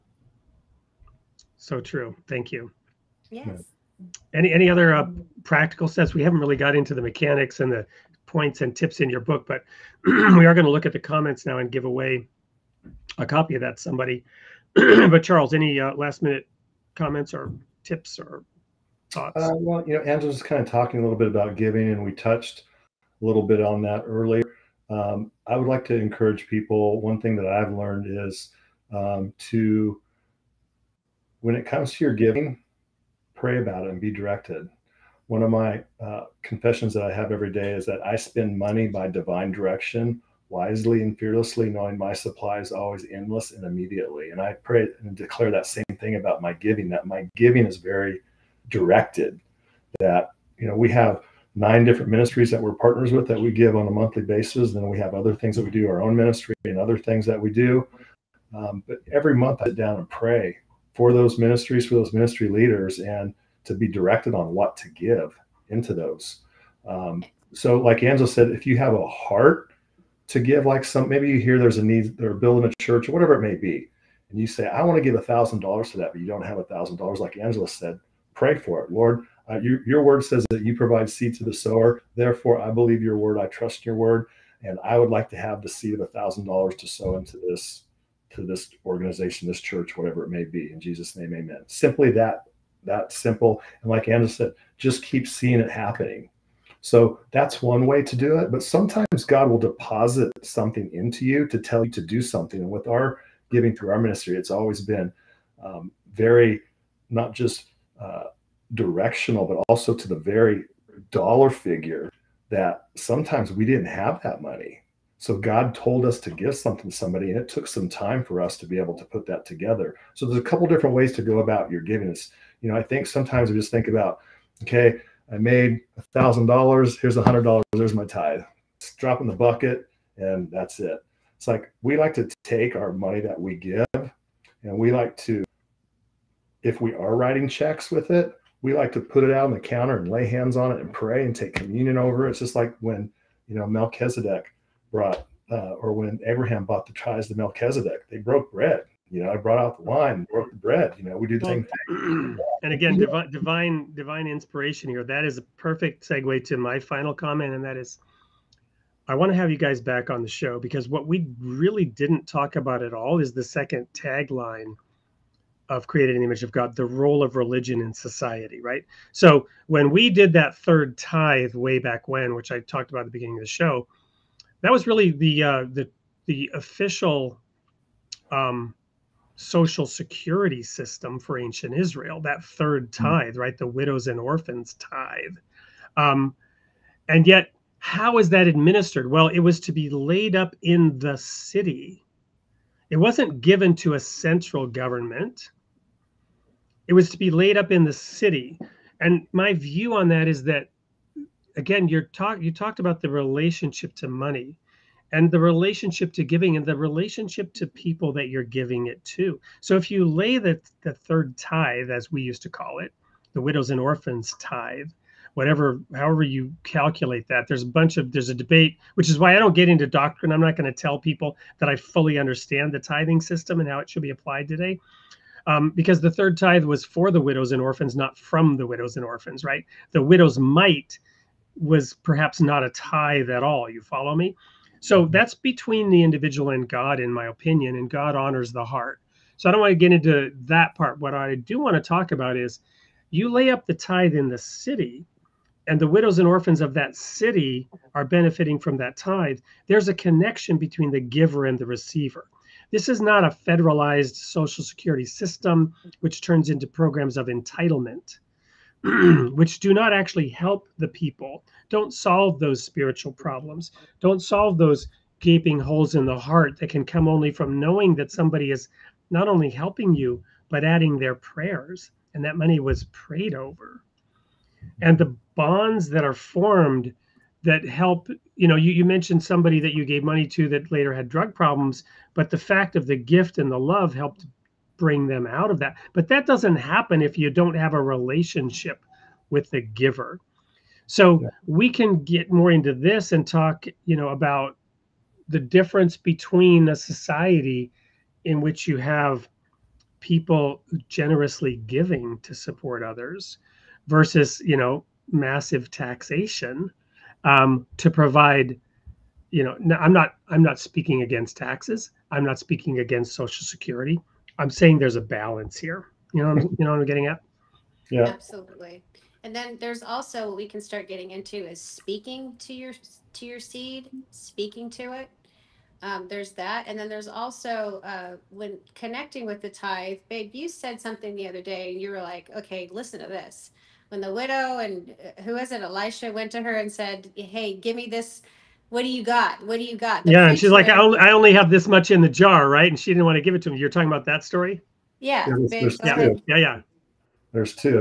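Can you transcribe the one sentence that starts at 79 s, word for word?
Uh, your word says that you provide seed to the sower.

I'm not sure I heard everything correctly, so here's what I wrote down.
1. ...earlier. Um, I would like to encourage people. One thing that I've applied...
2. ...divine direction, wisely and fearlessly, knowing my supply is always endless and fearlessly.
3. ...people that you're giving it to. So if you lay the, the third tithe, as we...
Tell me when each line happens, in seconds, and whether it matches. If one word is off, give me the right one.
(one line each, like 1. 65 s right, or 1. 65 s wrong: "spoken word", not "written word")
1. 24 s wrong: "learned", not "applied"
2. 39 s wrong: "immediately", not "fearlessly"
3. 207 s right.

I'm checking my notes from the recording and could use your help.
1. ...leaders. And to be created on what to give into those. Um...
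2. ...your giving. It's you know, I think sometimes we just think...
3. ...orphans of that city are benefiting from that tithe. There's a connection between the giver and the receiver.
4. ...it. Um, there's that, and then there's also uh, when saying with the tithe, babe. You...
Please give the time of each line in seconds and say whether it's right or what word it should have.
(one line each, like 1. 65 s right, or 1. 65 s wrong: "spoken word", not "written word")
1. 62 s wrong: "directed", not "created"
2. 121 s right
3. 246 s right
4. 324 s wrong: "connecting", not "saying".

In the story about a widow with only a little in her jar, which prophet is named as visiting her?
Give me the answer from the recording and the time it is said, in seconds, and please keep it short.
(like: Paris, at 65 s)
Elisha, at 335 s.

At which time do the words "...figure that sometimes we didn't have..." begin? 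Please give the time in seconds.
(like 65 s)
111 s.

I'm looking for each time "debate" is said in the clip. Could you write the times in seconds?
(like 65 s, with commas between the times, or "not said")
218 s.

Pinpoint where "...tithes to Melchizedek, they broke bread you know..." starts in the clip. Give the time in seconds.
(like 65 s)
146 s.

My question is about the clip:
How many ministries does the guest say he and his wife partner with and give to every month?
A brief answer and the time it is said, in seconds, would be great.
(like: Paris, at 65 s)
9, at 51 s.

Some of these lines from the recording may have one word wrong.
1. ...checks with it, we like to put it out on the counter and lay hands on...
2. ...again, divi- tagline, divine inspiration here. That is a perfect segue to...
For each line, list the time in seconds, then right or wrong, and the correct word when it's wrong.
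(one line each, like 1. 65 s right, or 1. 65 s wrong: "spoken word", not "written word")
1. 137 s right
2. 152 s wrong: "divine", not "tagline".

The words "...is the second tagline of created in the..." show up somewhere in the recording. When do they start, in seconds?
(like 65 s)
163 s.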